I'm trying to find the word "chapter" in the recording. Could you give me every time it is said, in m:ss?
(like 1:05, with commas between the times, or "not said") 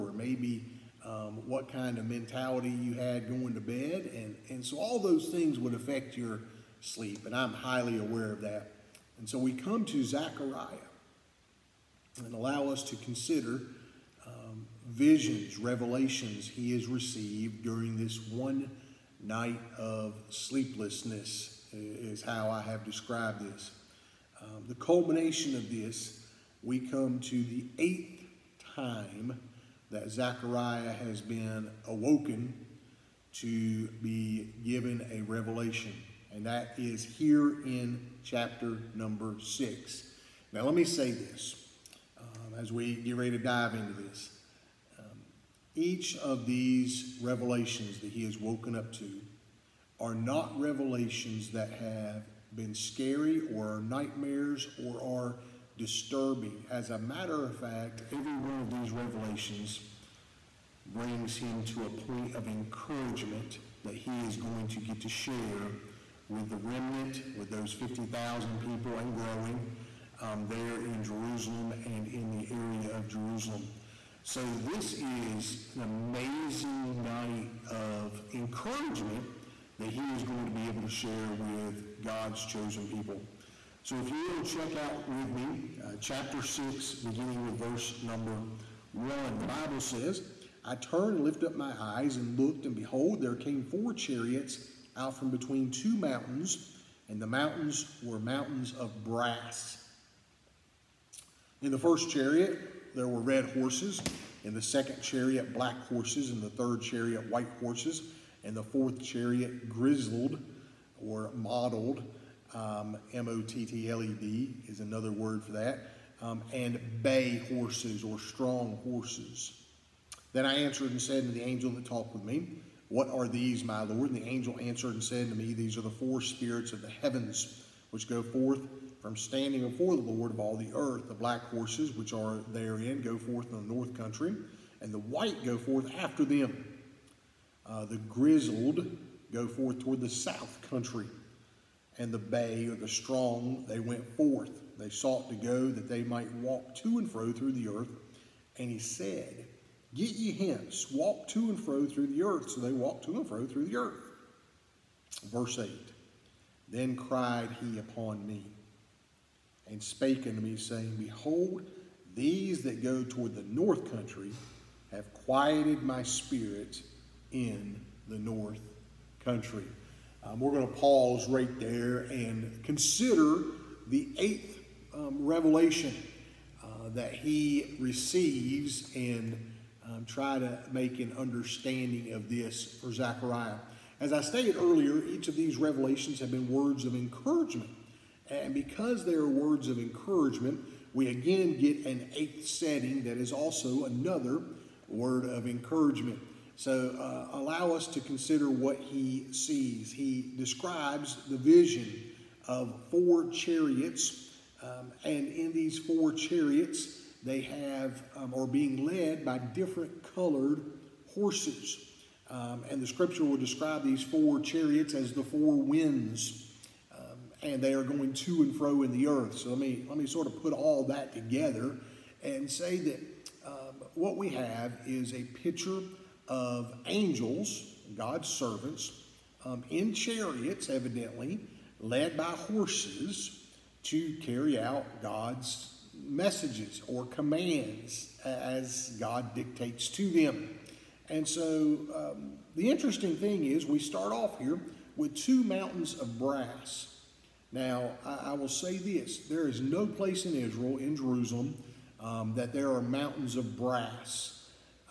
0:38, 1:25.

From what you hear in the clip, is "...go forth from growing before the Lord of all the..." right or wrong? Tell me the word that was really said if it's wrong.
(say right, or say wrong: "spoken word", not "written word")
wrong: "standing", not "growing".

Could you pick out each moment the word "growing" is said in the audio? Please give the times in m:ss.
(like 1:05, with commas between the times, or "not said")
1:09.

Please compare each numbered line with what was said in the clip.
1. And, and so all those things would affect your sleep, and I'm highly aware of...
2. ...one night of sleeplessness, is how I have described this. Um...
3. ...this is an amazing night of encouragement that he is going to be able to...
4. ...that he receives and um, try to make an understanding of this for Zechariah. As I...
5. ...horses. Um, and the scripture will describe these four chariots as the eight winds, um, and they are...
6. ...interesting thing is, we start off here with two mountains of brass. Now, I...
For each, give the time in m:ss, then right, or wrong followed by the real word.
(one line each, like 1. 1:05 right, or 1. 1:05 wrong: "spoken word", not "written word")
1. 0:04 right
2. 0:18 right
3. 1:14 right
4. 2:56 right
5. 3:31 wrong: "four", not "eight"
6. 4:02 right.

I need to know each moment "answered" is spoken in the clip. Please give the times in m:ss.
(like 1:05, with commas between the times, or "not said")
2:00, 2:04.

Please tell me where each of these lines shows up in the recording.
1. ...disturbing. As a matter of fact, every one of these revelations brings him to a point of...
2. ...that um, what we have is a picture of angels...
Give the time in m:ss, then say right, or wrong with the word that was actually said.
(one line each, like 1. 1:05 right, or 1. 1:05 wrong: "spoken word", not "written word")
1. 0:55 right
2. 3:42 right.